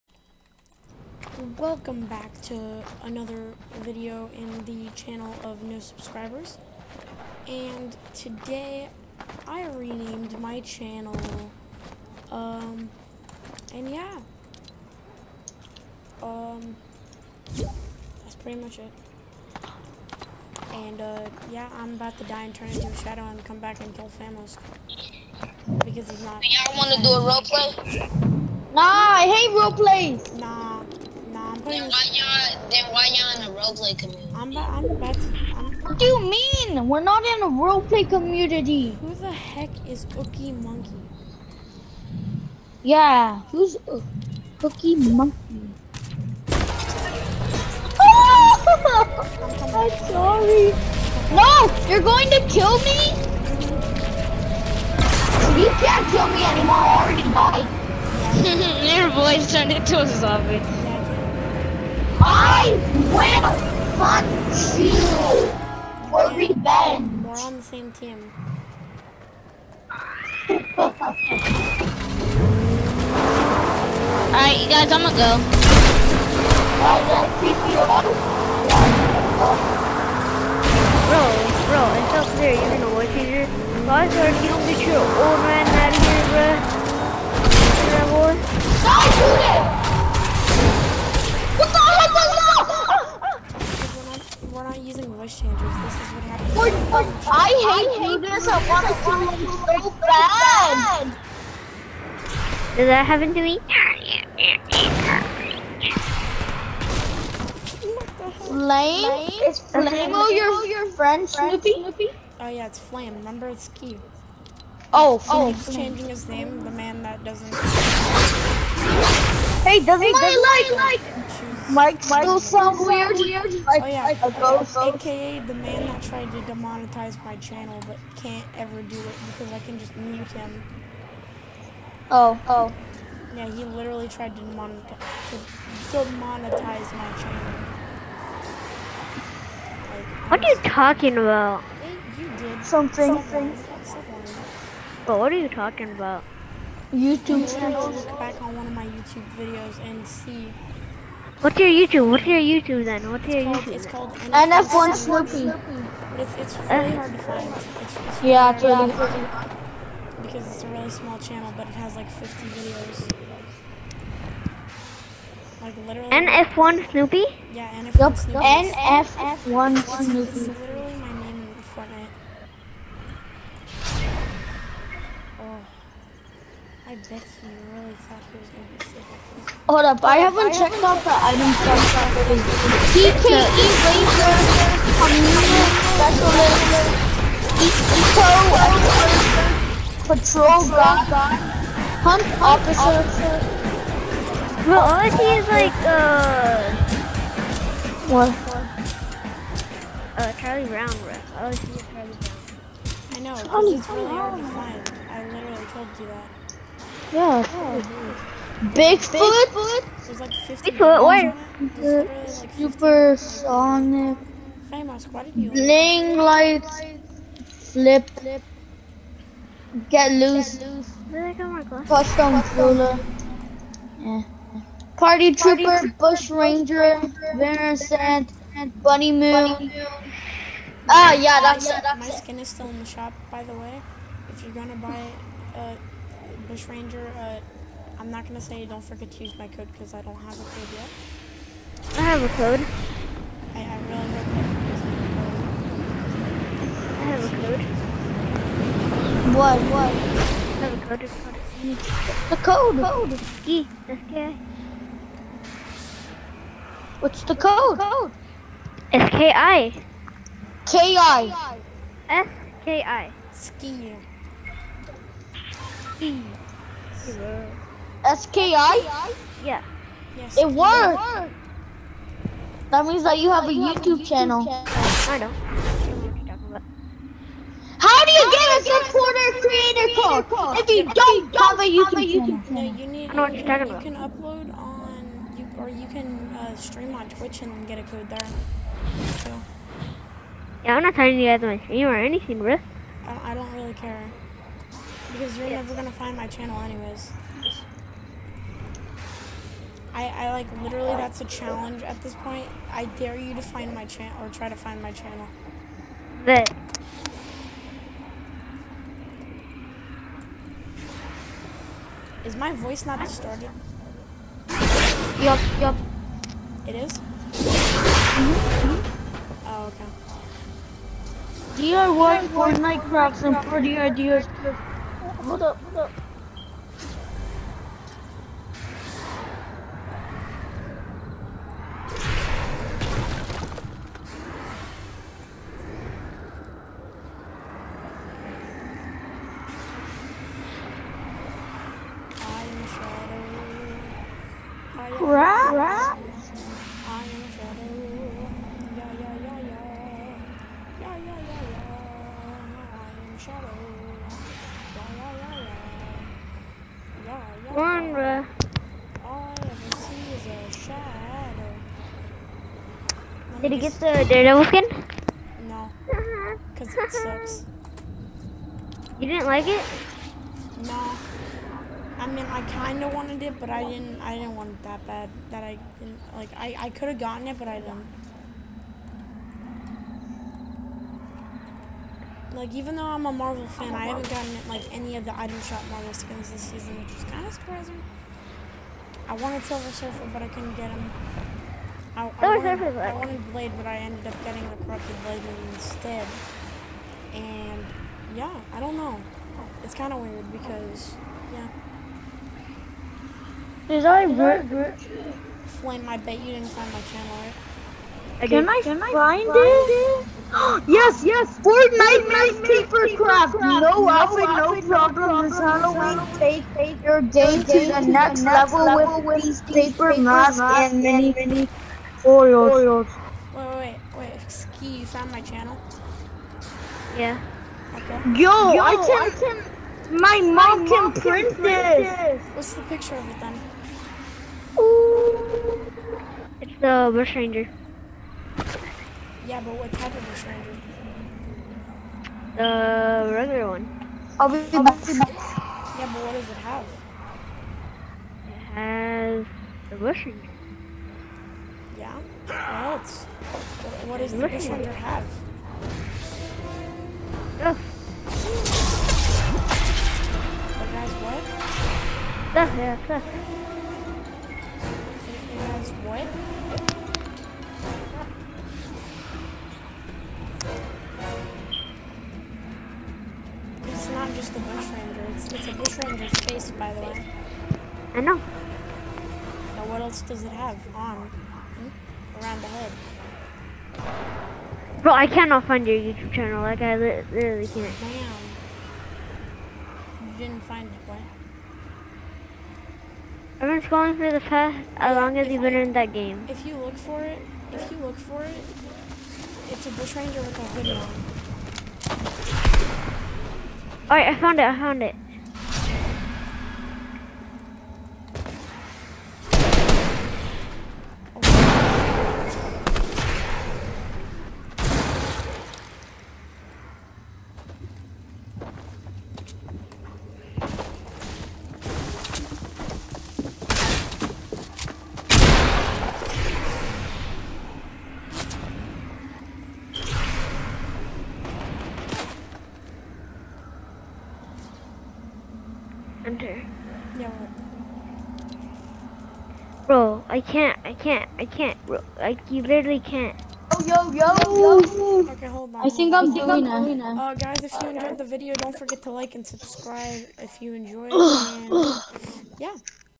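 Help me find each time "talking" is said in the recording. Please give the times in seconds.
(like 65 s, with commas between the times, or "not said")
140 s, 145 s, 283 s.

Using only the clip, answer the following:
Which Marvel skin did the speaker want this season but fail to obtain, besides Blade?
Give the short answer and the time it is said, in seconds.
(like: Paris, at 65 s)
Silver Surfer, at 389 s.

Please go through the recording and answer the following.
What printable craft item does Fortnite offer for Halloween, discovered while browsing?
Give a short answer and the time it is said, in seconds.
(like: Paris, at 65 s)
paper masks, at 419 s.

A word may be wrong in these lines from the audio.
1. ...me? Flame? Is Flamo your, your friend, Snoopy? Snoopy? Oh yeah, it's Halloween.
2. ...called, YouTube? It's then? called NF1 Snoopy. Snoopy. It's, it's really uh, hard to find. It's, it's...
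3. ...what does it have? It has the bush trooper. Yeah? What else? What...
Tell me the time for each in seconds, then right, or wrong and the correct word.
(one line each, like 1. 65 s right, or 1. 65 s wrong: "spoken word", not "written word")
1. 103 s wrong: "Flame", not "Halloween"
2. 153 s right
3. 446 s wrong: "ranger", not "trooper".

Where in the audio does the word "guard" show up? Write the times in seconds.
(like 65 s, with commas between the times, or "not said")
190 s.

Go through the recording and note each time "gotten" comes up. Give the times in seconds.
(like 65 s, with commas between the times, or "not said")
376 s, 384 s.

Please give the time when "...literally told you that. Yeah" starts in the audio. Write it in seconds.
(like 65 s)
205 s.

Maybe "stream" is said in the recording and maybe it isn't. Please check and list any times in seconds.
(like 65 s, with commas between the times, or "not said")
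286 s, 291 s.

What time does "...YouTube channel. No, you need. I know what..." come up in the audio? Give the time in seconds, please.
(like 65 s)
281 s.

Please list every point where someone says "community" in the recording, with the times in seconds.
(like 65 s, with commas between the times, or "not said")
33 s, 38 s, 184 s.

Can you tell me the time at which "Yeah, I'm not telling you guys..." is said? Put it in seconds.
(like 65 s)
290 s.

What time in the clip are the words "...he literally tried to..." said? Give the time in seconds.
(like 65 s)
133 s.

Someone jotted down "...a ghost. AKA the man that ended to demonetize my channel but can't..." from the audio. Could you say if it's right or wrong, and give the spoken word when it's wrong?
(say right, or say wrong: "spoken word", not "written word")
wrong: "tried", not "ended".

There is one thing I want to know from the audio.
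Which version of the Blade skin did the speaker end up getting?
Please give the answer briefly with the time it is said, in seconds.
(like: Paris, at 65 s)
corrupted Blade, at 394 s.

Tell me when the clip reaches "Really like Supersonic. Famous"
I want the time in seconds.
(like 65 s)
211 s.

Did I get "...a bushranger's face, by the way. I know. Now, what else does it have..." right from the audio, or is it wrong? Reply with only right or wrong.
right.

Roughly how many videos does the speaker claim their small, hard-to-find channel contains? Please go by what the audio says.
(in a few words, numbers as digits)
50.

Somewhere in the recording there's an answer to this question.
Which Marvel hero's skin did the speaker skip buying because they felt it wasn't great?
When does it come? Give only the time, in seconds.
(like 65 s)
364 s.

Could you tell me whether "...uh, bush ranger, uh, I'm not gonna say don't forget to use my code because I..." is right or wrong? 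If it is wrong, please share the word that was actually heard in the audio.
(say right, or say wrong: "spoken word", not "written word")
right.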